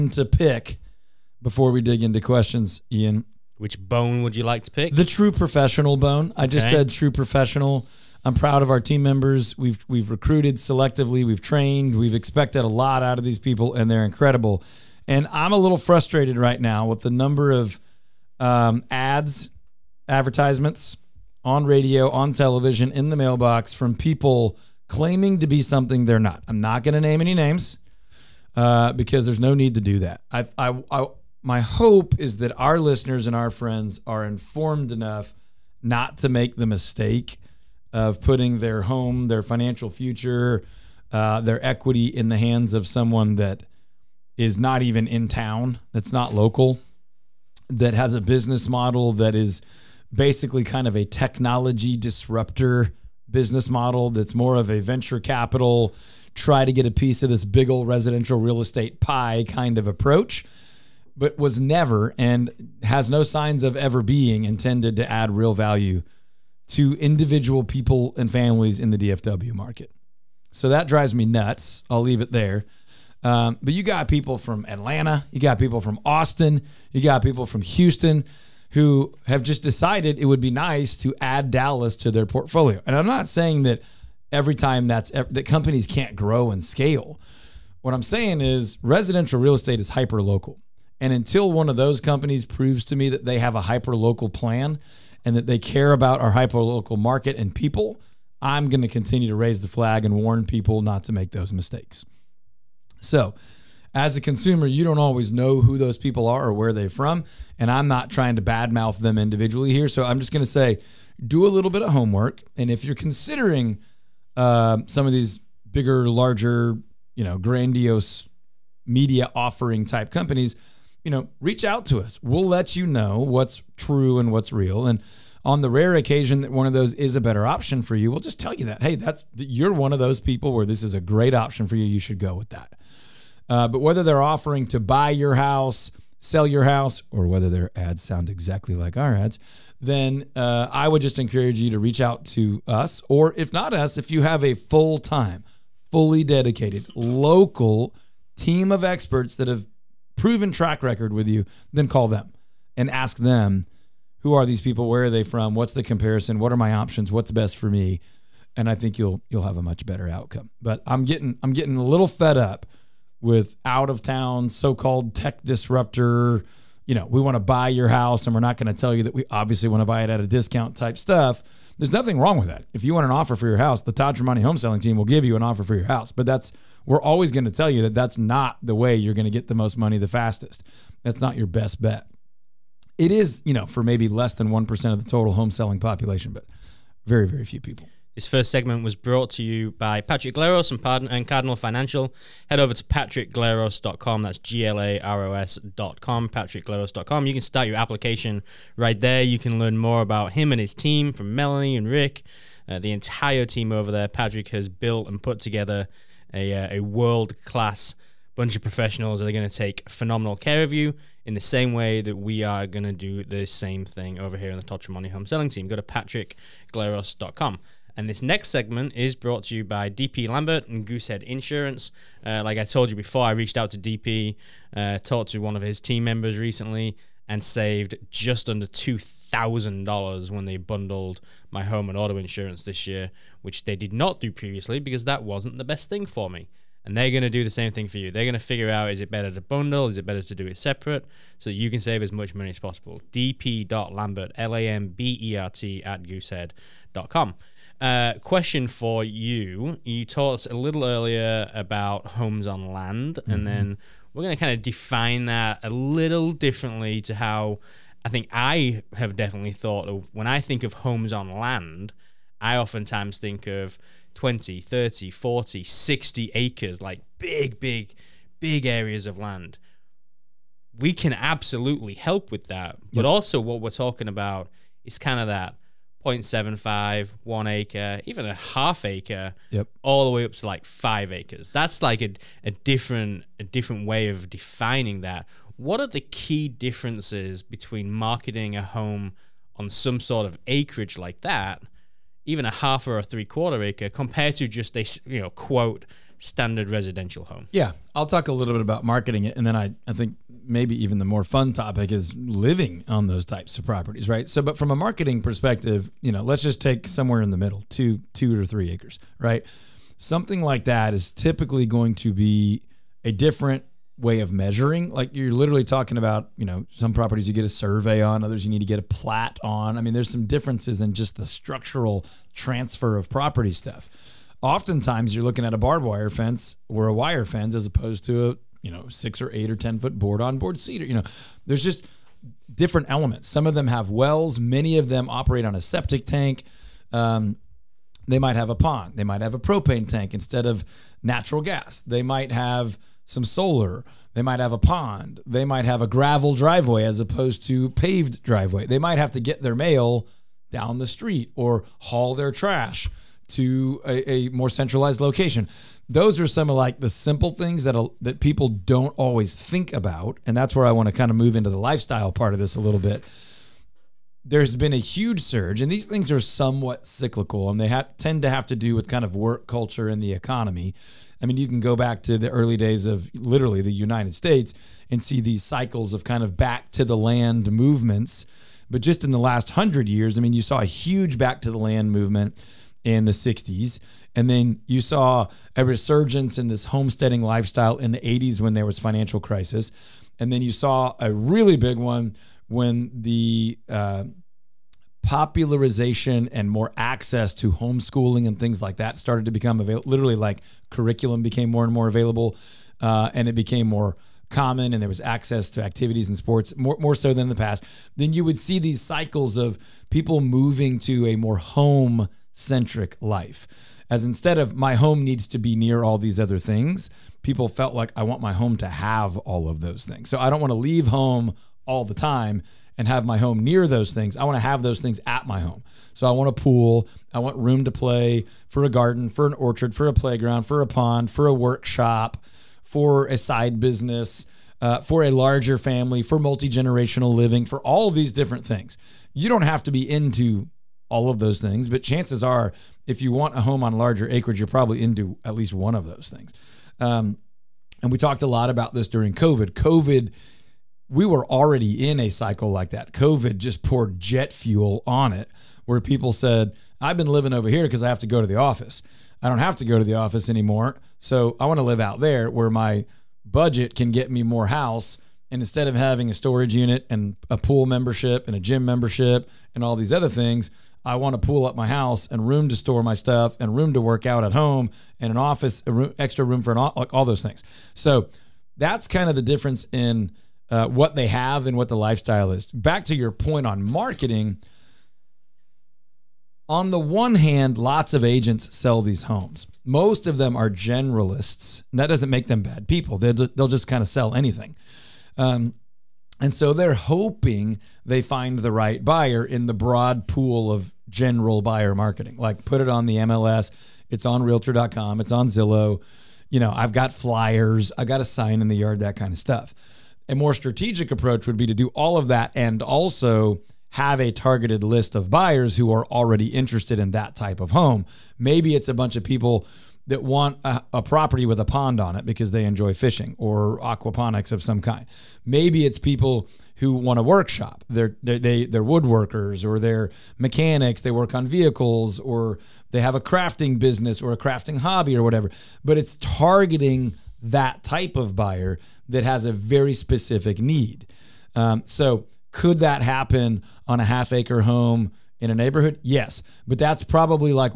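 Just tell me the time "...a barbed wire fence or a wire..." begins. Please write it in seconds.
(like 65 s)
325 s.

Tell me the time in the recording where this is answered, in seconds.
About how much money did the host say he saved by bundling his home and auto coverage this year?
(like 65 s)
228 s.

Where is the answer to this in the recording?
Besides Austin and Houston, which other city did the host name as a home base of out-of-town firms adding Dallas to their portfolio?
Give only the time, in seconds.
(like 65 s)
74 s.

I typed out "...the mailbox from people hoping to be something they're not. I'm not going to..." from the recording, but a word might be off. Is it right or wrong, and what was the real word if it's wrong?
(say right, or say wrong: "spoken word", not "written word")
wrong: "claiming", not "hoping".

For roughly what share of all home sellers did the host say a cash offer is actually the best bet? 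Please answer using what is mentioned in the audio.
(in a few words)
less than 1%.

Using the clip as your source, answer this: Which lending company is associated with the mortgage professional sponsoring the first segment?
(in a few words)
Cardinal Financial.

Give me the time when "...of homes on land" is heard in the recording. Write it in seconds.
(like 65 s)
260 s.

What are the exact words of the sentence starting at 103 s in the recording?
So, as a consumer, you don't always know who those people are or where they're from.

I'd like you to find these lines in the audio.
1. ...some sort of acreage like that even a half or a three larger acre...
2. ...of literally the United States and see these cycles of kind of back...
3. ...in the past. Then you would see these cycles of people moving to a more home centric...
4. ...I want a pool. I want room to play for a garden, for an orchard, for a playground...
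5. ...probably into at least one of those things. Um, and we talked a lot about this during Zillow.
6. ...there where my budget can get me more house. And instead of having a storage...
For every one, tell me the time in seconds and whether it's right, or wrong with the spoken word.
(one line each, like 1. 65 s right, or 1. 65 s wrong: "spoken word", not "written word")
1. 289 s wrong: "quarter", not "larger"
2. 372 s right
3. 407 s right
4. 426 s right
5. 444 s wrong: "COVID", not "Zillow"
6. 461 s right.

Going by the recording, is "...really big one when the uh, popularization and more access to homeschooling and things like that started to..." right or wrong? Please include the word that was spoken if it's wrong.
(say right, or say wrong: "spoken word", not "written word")
right.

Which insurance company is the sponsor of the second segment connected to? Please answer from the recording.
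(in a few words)
Goosehead Insurance.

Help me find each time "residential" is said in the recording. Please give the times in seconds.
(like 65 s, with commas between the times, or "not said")
57 s, 88 s, 296 s.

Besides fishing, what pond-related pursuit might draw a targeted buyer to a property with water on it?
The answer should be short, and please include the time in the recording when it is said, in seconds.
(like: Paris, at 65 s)
aquaponics, at 523 s.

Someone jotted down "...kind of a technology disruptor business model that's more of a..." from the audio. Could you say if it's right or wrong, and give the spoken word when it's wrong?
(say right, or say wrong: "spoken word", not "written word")
right.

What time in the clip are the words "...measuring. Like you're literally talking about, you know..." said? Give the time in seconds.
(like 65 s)
314 s.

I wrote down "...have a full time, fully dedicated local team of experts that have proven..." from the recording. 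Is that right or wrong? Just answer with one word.
right.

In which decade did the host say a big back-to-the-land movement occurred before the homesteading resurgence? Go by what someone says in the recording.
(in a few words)
1960s.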